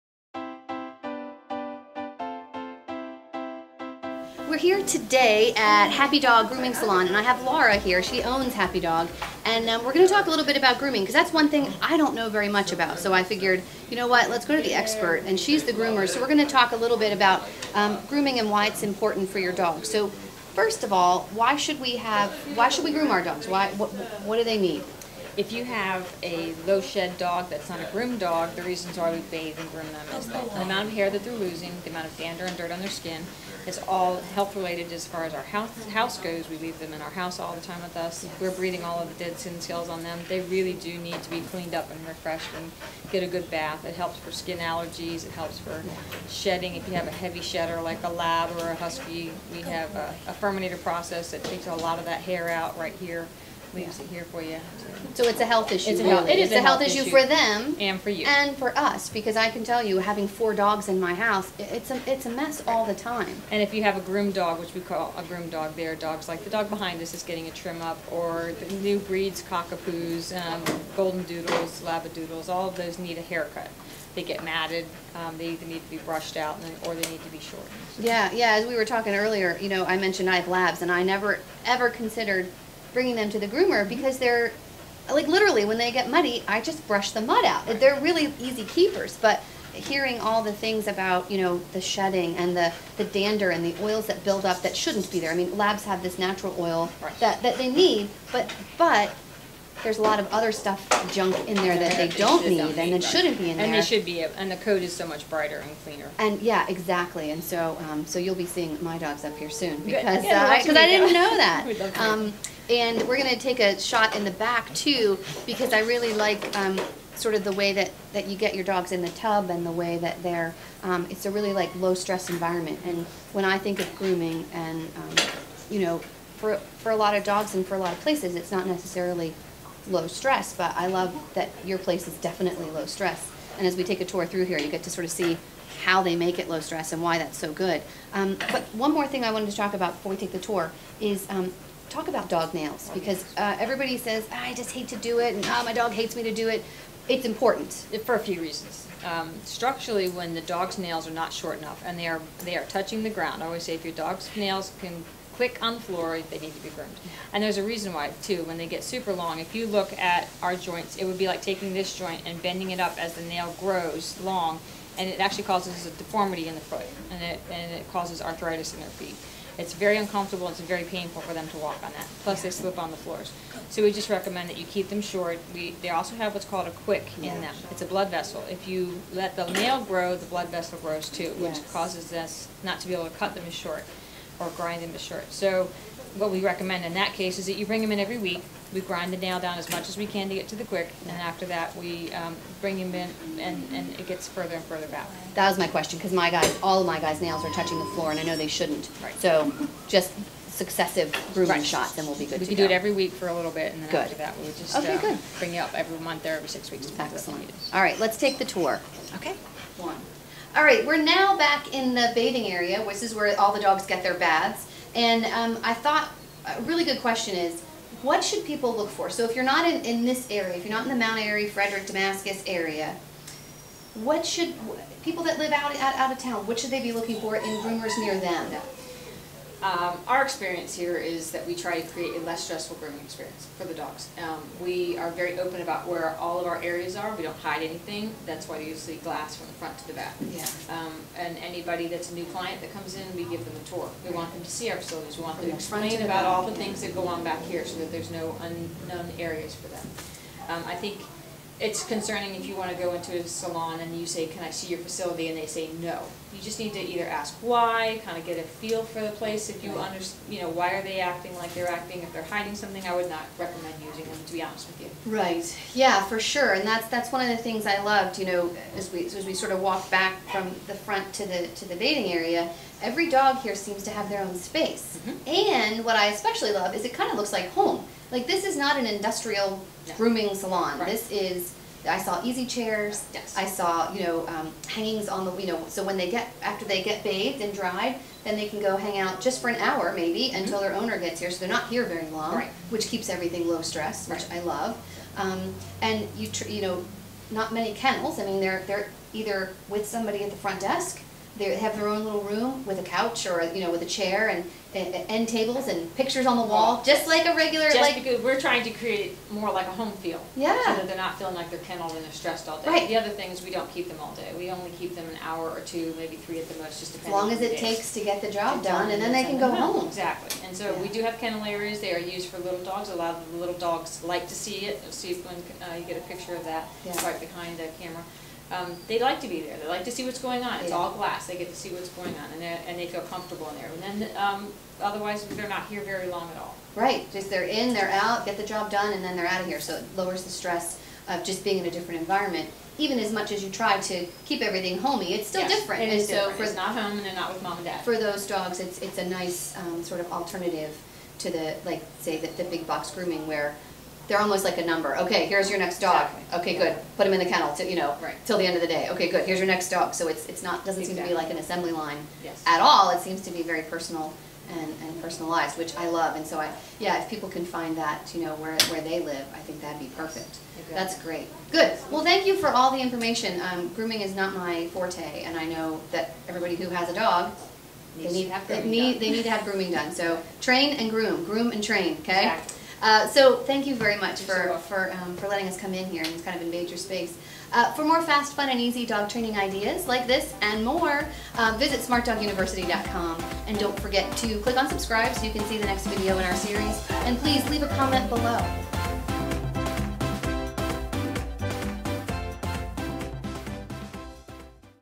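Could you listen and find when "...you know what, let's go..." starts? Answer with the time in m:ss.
0:13.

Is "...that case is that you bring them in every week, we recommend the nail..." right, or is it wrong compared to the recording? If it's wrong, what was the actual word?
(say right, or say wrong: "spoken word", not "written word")
wrong: "grind", not "recommend".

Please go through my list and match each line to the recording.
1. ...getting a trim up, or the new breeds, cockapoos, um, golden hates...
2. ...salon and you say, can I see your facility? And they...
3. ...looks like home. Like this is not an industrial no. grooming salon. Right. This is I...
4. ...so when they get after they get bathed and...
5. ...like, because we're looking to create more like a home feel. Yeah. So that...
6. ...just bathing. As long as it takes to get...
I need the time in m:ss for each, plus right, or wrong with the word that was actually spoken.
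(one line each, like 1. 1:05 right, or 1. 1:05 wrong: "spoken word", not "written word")
1. 1:07 wrong: "doodles", not "hates"
2. 4:13 right
3. 4:37 right
4. 4:45 right
5. 5:07 wrong: "trying", not "looking"
6. 5:16 wrong: "depending", not "bathing".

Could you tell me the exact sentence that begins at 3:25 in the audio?
bring you up every month or every six weeks.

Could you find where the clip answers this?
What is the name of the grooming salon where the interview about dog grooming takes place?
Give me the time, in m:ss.
0:05.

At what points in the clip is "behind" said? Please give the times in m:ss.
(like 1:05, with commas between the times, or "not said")
1:06, 5:27.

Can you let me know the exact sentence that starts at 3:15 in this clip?
That was my question, because my guys, all of my guys' nails are touching the floor, and I know they shouldn't.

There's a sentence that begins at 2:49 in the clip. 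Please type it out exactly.
It's very uncomfortable, it's very painful for them to walk on that, plus they slip on the floors.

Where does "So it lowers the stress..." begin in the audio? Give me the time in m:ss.
5:39.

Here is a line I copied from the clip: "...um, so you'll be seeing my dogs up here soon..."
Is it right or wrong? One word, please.
right.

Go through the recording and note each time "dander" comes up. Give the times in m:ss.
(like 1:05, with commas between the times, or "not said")
0:32, 1:33.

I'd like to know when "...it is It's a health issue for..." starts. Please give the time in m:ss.
0:56.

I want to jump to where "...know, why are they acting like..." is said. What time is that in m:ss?
4:20.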